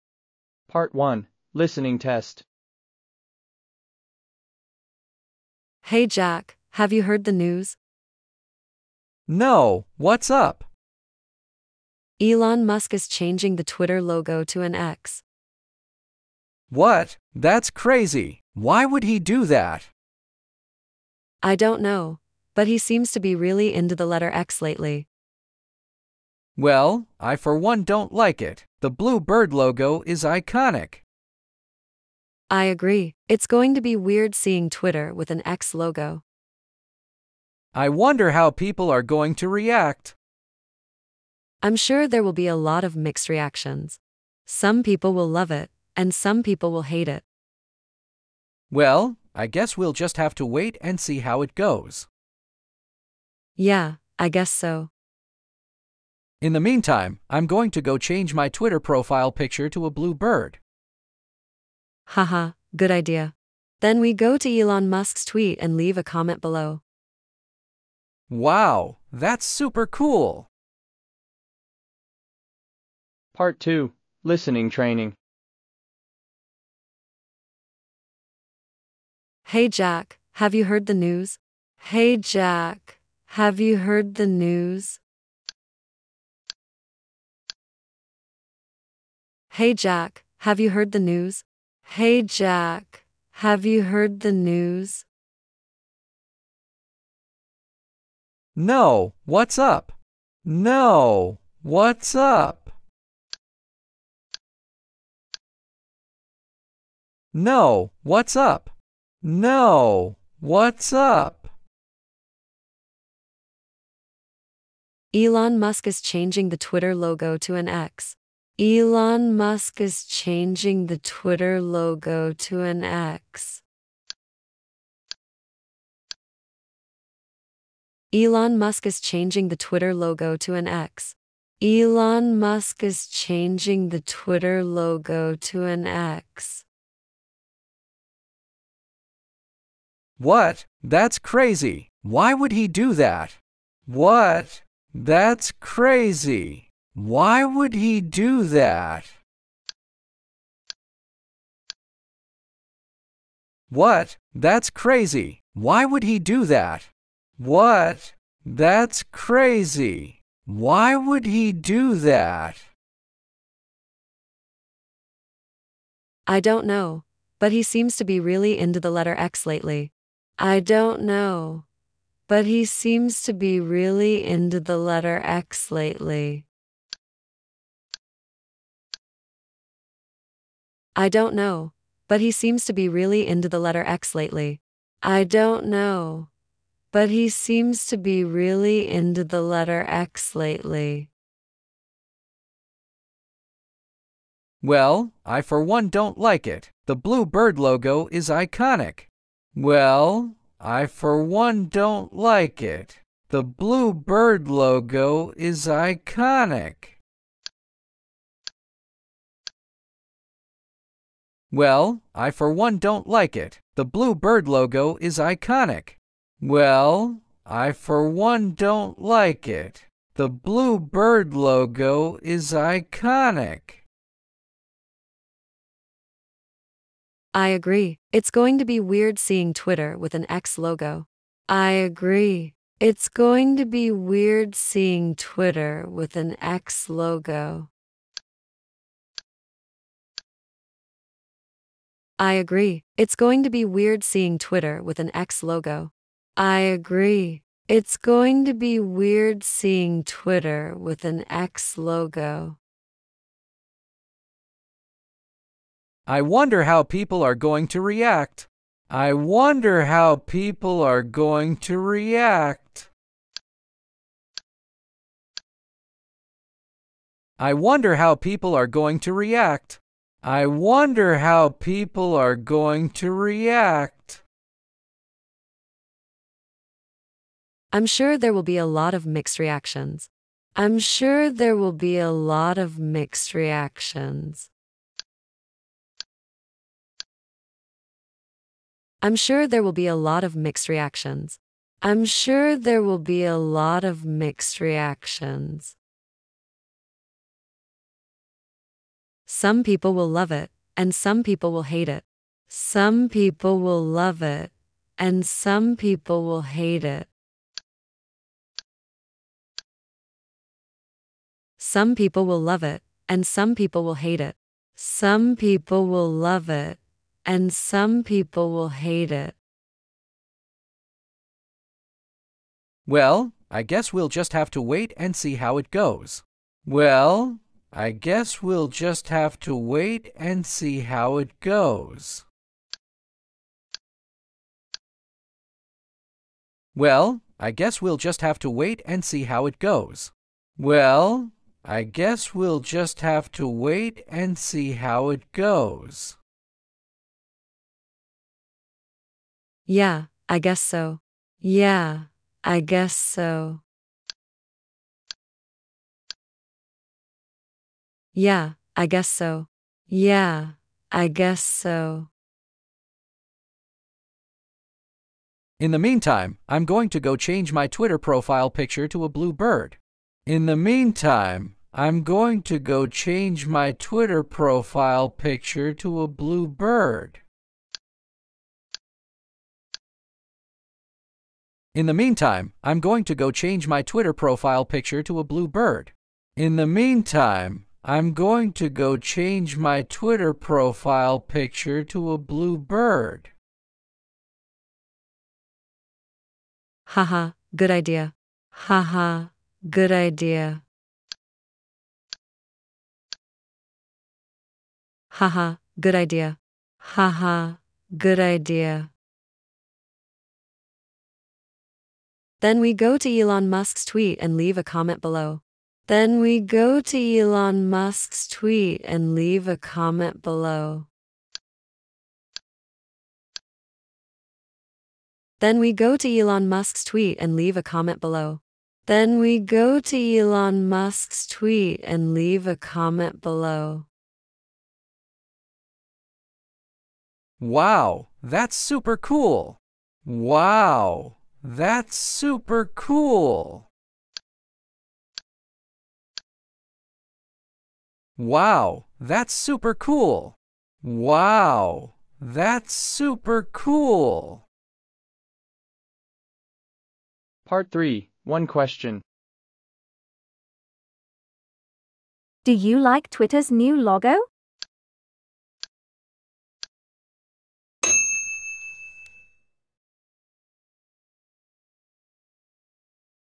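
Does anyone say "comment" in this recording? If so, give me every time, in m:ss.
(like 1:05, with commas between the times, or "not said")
1:06, 6:54, 6:59, 7:07, 7:12.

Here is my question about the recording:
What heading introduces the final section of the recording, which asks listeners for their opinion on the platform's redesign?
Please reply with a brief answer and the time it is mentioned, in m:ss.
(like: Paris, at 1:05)
One Question, at 7:38.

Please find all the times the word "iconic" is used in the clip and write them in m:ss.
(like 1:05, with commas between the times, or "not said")
0:30, 3:18, 3:25, 3:35, 3:42.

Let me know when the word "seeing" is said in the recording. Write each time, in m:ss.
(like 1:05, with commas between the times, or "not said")
0:34, 3:49, 3:54, 4:04, 4:09.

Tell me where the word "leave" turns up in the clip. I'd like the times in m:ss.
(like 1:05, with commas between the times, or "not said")
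1:05, 6:54, 6:59, 7:07, 7:12.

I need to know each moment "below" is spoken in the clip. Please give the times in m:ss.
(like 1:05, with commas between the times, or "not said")
1:06, 6:55, 7:00, 7:07, 7:13.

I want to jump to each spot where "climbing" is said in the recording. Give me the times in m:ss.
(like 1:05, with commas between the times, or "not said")
not said.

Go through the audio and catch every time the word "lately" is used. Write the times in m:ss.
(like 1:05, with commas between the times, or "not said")
0:24, 2:49, 2:55, 3:04, 3:10.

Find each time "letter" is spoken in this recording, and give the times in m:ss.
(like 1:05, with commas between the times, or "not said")
0:24, 2:48, 2:54, 3:03, 3:09.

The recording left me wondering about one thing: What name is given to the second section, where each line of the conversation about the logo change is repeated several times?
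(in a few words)
Listening Training.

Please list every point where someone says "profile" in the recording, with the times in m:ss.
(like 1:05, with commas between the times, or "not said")
0:58, 6:07, 6:14, 6:24, 6:30.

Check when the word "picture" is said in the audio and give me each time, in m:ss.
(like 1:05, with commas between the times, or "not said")
0:59, 6:08, 6:15, 6:24, 6:31.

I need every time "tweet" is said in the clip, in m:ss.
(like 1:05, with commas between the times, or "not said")
1:05, 6:53, 6:58, 7:06, 7:11.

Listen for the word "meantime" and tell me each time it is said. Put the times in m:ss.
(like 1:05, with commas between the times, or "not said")
0:56, 6:05, 6:10, 6:21, 6:26.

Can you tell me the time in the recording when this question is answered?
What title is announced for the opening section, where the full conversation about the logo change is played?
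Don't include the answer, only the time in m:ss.
0:01.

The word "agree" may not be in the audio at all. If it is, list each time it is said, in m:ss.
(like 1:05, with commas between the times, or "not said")
0:32, 3:47, 3:51, 4:02, 4:06.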